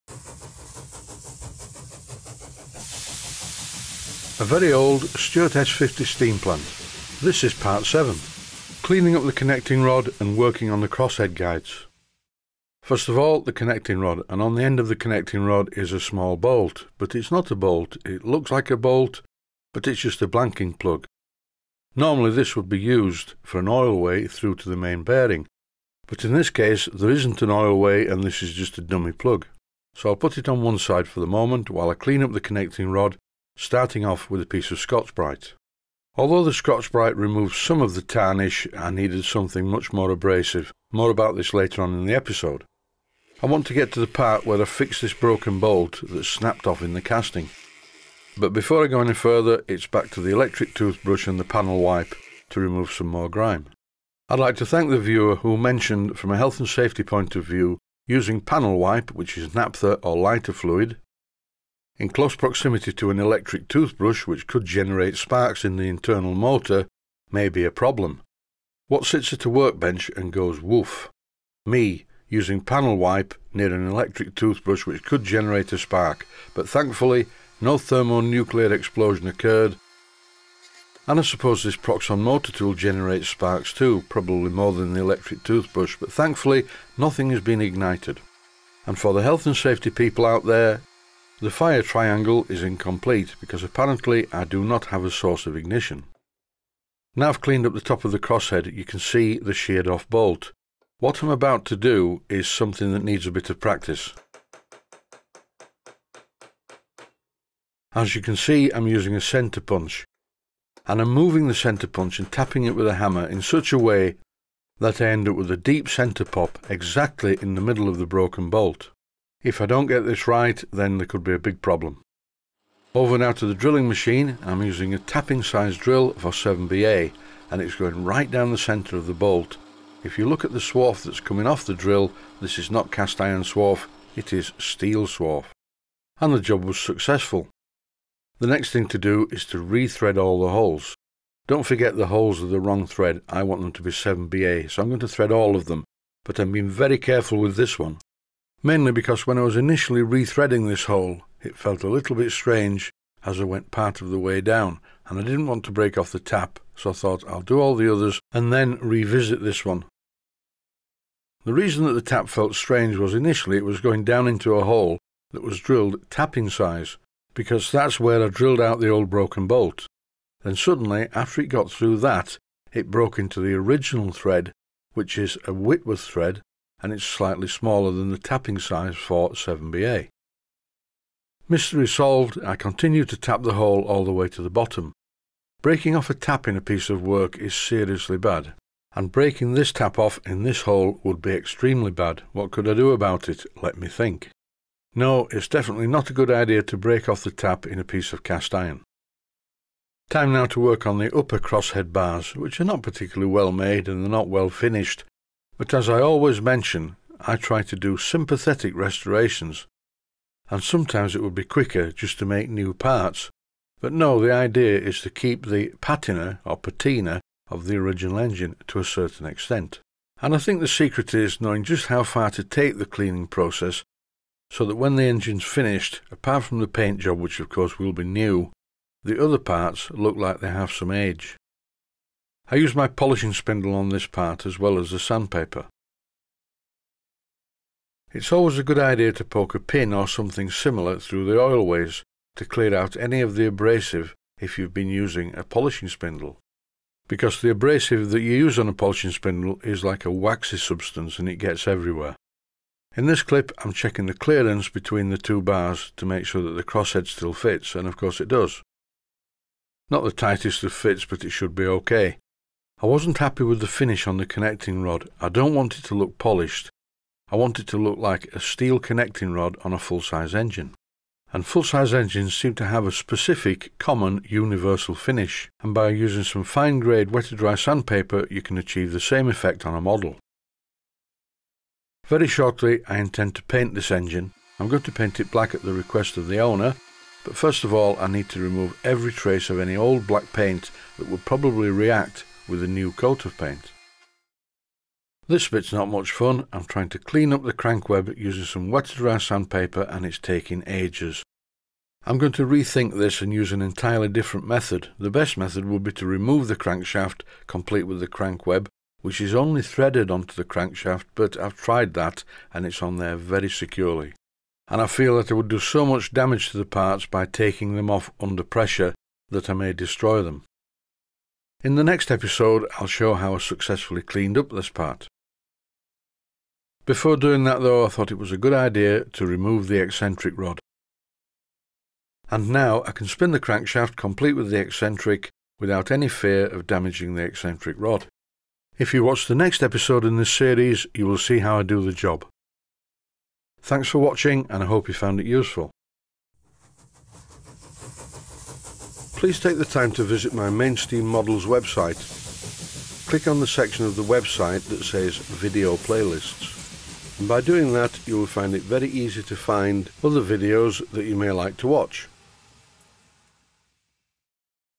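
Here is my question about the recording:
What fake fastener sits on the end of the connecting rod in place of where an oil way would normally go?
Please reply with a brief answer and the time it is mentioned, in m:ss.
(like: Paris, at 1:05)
Blanking plug, at 0:20.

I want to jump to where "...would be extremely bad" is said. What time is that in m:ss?
3:11.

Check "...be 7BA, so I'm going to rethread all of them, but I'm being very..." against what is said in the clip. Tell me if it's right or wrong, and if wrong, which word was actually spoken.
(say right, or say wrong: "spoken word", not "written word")
wrong: "thread", not "rethread".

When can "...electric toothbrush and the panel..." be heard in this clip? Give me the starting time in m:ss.
0:50.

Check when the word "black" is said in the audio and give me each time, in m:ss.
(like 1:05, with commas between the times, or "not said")
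4:45, 4:50.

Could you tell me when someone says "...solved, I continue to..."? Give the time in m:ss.
3:01.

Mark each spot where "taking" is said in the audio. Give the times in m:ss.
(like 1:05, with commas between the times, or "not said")
5:00, 5:17.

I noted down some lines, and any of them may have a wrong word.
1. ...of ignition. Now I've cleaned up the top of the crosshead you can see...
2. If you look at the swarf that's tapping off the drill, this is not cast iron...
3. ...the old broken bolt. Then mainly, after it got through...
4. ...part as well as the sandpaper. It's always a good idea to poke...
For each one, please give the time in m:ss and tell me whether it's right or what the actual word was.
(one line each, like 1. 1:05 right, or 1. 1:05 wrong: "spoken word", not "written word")
1. 1:35 right
2. 2:10 wrong: "coming", not "tapping"
3. 2:48 wrong: "suddenly", not "mainly"
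4. 3:54 right.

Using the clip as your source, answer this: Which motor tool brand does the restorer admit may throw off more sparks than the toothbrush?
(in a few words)
Proxxon.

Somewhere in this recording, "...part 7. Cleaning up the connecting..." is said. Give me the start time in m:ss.
0:07.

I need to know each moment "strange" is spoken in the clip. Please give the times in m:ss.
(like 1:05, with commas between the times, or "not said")
2:32, 2:42.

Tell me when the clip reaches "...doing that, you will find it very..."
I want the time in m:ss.
5:57.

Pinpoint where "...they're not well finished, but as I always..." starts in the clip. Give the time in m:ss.
3:24.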